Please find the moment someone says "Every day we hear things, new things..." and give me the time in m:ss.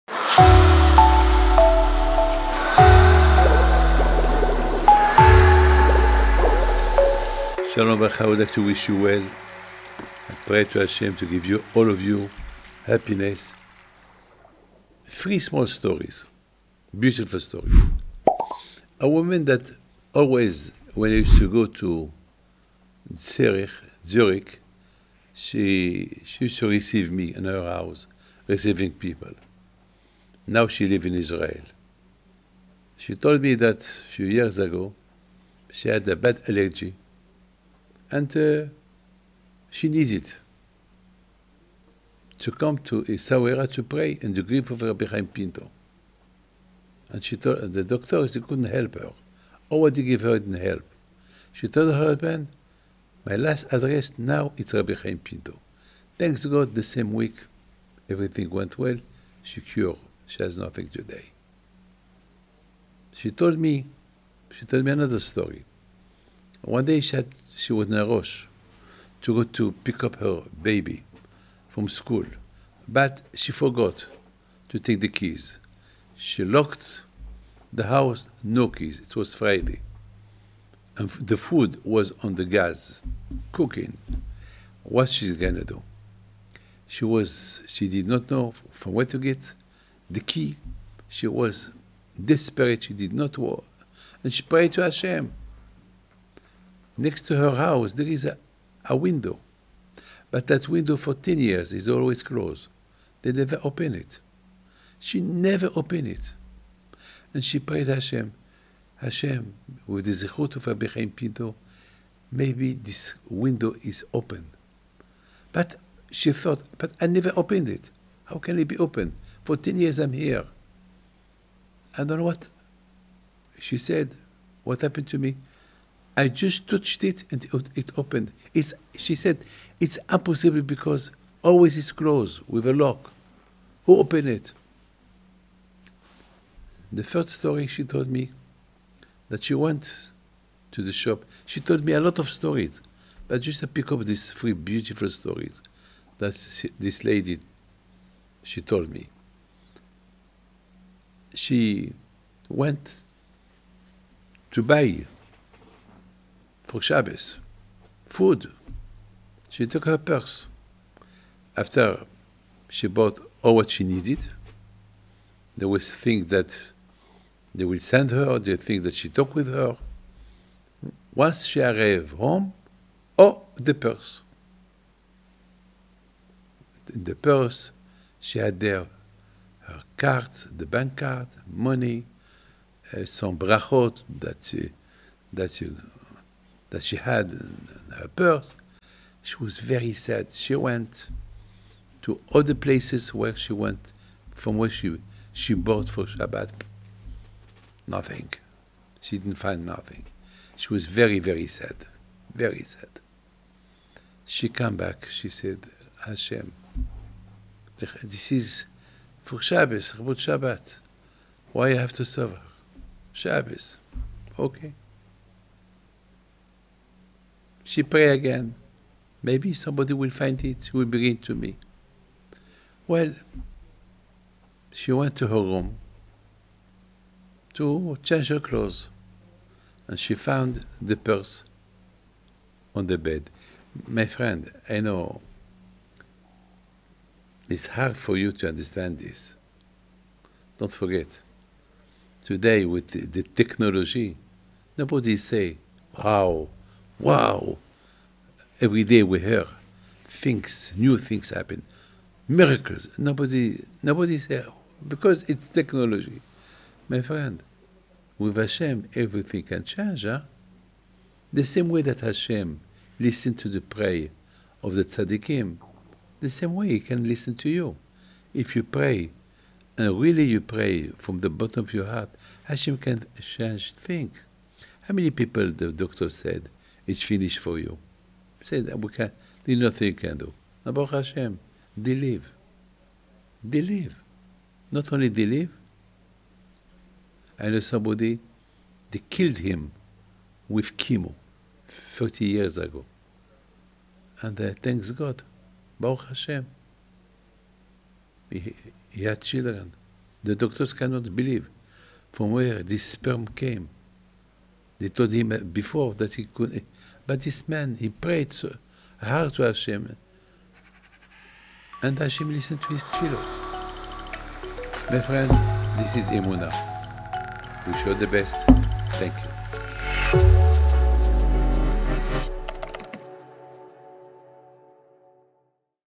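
4:08.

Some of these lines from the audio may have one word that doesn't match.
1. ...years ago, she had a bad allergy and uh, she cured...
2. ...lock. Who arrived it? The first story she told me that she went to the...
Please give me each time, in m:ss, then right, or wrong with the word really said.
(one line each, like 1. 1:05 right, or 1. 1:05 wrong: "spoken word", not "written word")
1. 0:34 wrong: "needed", not "cured"
2. 2:12 wrong: "opened", not "arrived".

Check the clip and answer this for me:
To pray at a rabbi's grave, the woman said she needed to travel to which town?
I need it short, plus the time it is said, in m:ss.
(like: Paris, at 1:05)
Essaouira, at 0:43.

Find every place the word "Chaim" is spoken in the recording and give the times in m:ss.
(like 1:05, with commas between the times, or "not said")
0:45, 0:54.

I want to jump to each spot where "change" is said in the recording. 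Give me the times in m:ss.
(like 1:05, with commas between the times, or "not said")
3:48, 4:19, 4:33.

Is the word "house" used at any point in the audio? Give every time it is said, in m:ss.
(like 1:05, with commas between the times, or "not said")
0:27, 1:17, 1:37.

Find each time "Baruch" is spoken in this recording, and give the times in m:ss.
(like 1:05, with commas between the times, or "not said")
4:40, 4:55.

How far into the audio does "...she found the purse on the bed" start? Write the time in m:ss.
3:49.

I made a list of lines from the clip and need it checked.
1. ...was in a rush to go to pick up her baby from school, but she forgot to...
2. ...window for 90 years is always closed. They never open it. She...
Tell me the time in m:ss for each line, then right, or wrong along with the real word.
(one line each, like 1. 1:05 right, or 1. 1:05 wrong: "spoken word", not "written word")
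1. 1:07 right
2. 1:40 wrong: "10", not "90".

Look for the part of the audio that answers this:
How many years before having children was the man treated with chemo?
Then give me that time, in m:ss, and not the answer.
4:51.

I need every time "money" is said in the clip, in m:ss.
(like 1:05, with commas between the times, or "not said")
3:01.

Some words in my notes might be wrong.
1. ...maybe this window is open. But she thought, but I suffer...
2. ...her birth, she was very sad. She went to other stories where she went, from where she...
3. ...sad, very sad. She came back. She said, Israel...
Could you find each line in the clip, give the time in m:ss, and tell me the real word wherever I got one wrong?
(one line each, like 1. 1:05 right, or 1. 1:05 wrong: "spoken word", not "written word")
1. 1:52 wrong: "never", not "suffer"
2. 3:07 wrong: "places", not "stories"
3. 3:21 wrong: "Hashem", not "Israel".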